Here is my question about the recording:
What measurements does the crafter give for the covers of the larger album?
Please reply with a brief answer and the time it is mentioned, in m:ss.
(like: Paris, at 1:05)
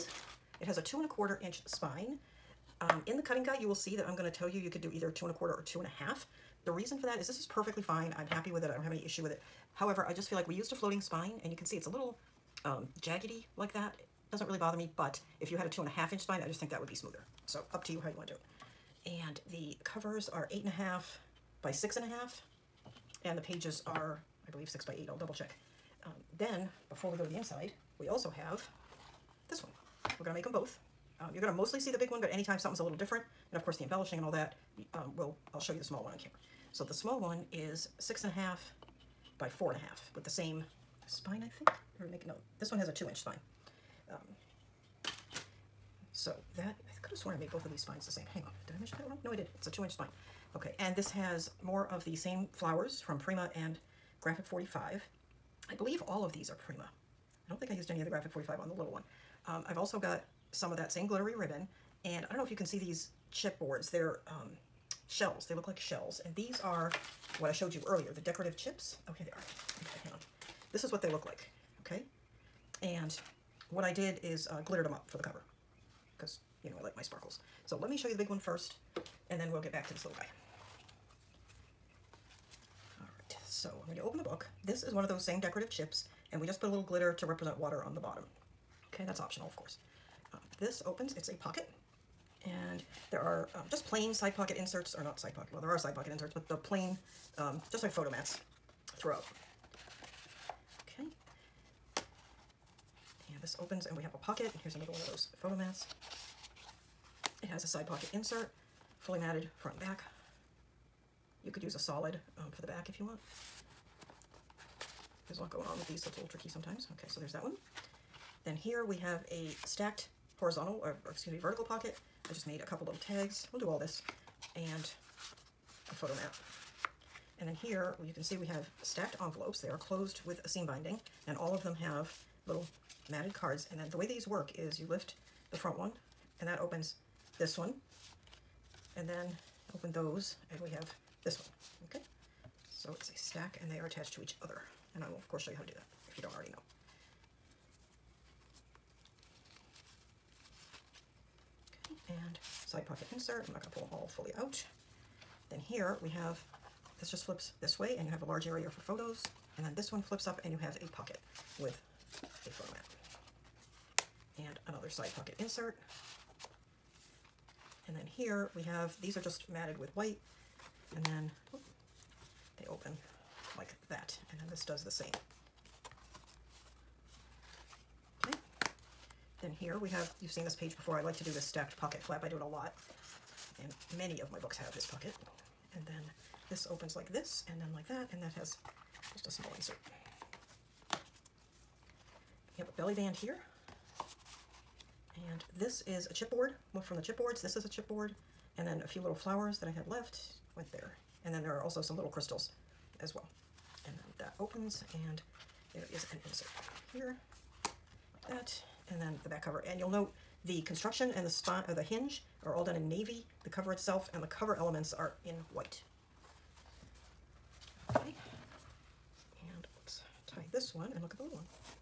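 8.5 by 6.5 inches, at 0:20.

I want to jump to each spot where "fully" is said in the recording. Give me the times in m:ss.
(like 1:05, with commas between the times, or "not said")
1:48, 2:34.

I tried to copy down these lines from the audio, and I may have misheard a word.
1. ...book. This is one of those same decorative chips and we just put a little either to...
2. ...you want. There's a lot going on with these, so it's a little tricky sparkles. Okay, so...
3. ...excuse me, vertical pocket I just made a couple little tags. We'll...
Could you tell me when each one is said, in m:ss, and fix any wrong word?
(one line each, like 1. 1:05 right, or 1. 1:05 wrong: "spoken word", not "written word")
1. 1:24 wrong: "glitter", not "either"
2. 1:52 wrong: "sometimes", not "sparkles"
3. 2:01 right.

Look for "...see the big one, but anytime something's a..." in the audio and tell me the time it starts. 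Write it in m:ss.
0:31.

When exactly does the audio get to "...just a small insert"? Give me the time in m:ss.
3:09.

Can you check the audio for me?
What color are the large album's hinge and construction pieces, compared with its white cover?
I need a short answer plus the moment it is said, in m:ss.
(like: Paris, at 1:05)
Navy, at 3:32.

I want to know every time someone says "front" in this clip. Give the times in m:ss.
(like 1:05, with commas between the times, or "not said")
1:49, 2:15.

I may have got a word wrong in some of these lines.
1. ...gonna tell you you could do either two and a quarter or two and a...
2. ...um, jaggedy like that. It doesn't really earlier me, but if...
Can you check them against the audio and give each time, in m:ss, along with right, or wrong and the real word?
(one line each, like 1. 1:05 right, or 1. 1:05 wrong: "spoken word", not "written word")
1. 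0:04 right
2. 0:12 wrong: "bother", not "earlier".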